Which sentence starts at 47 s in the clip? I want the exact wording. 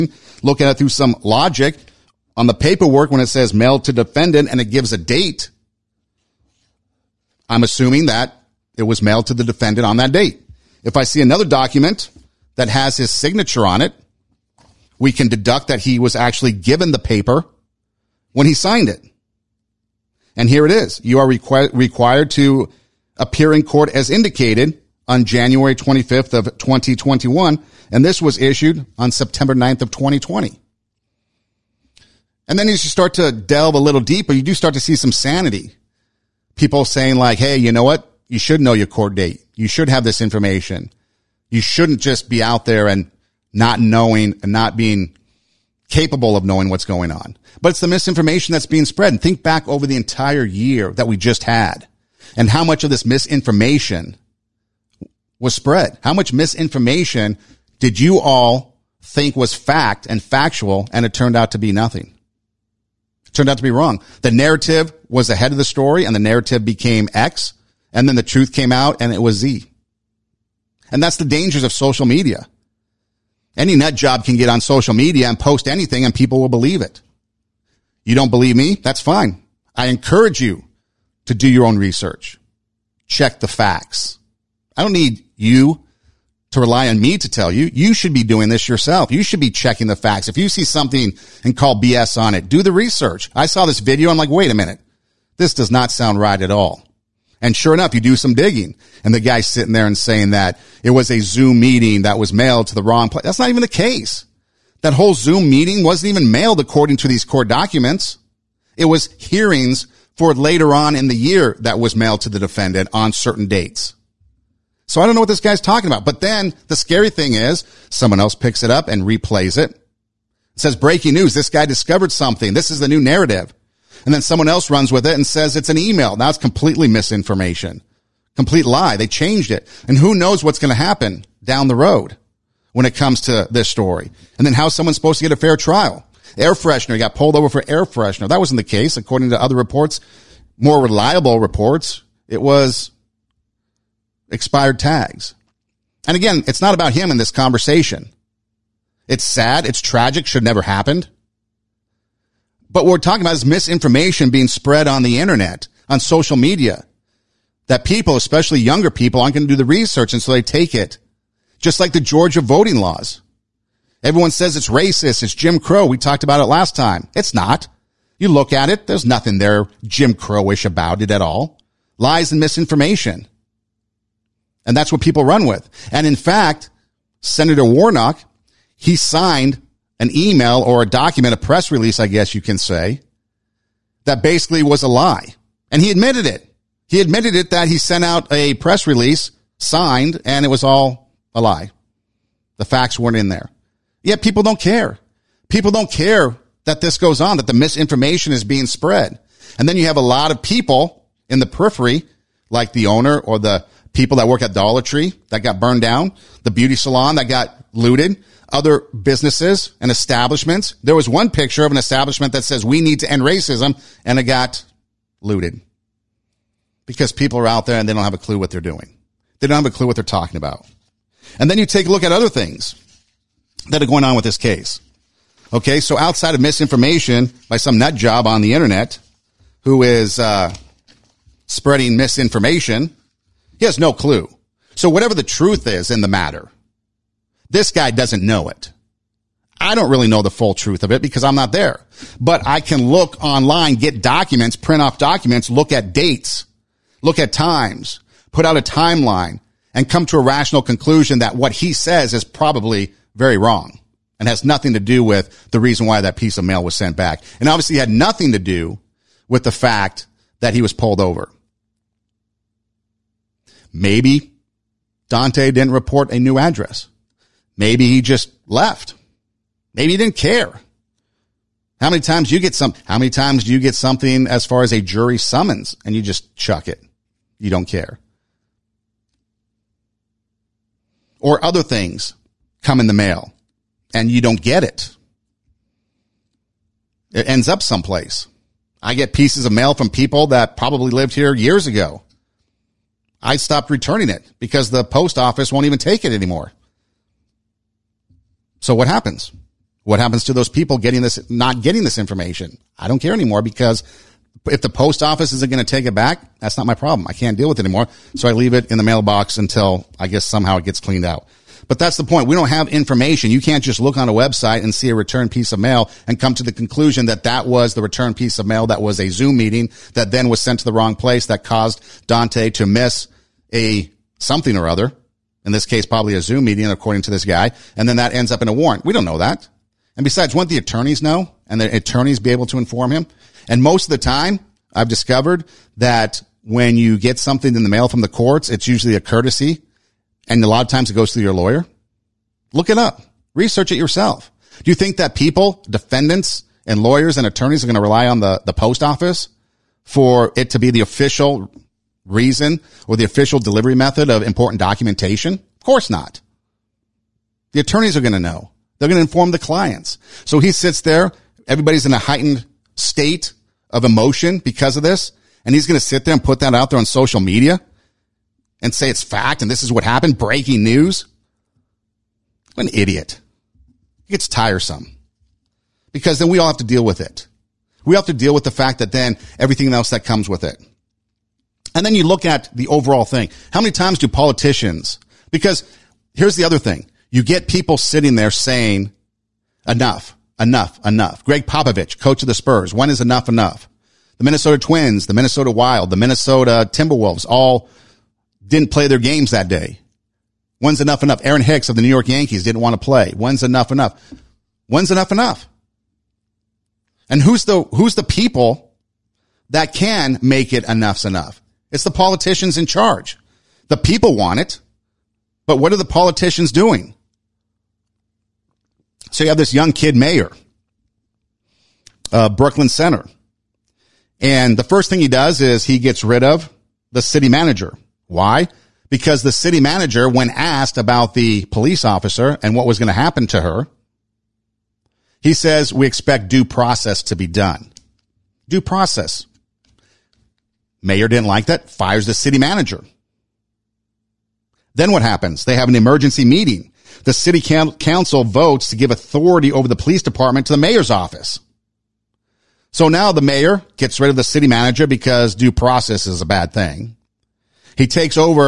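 But it's the misinformation that's being spread.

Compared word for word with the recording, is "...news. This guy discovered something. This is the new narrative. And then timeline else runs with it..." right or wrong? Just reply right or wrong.
wrong.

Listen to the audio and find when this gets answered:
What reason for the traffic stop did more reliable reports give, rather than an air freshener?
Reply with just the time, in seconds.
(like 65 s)
144 s.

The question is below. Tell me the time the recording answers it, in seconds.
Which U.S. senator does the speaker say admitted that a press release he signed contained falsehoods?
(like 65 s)
177 s.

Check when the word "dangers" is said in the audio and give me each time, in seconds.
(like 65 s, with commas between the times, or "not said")
71 s.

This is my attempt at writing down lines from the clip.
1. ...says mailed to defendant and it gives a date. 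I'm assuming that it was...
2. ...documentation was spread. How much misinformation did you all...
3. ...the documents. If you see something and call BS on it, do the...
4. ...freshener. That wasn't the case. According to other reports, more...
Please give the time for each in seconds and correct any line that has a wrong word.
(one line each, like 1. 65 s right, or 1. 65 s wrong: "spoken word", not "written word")
1. 3 s right
2. 53 s wrong: "misinformation", not "documentation"
3. 89 s wrong: "facts", not "documents"
4. 137 s right.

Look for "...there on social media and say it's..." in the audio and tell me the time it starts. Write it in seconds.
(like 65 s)
366 s.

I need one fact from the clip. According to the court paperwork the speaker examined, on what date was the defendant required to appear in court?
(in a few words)
January 25, 2021.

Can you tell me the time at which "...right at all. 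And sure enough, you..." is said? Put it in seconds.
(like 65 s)
96 s.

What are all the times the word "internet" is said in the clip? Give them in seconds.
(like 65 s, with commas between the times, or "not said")
155 s, 228 s.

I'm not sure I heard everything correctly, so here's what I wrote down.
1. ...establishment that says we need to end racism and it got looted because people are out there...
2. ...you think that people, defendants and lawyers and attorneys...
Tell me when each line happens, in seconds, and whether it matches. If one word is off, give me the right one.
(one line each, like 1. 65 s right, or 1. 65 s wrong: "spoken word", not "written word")
1. 211 s right
2. 344 s right.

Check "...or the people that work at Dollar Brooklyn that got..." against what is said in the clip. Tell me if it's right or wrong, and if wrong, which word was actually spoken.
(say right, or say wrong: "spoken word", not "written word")
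wrong: "Tree", not "Brooklyn".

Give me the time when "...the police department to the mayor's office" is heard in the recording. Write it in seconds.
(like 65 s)
449 s.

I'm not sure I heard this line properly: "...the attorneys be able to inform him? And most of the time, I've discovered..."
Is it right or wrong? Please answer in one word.
right.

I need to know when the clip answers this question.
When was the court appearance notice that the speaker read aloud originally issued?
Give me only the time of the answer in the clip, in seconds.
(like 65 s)
29 s.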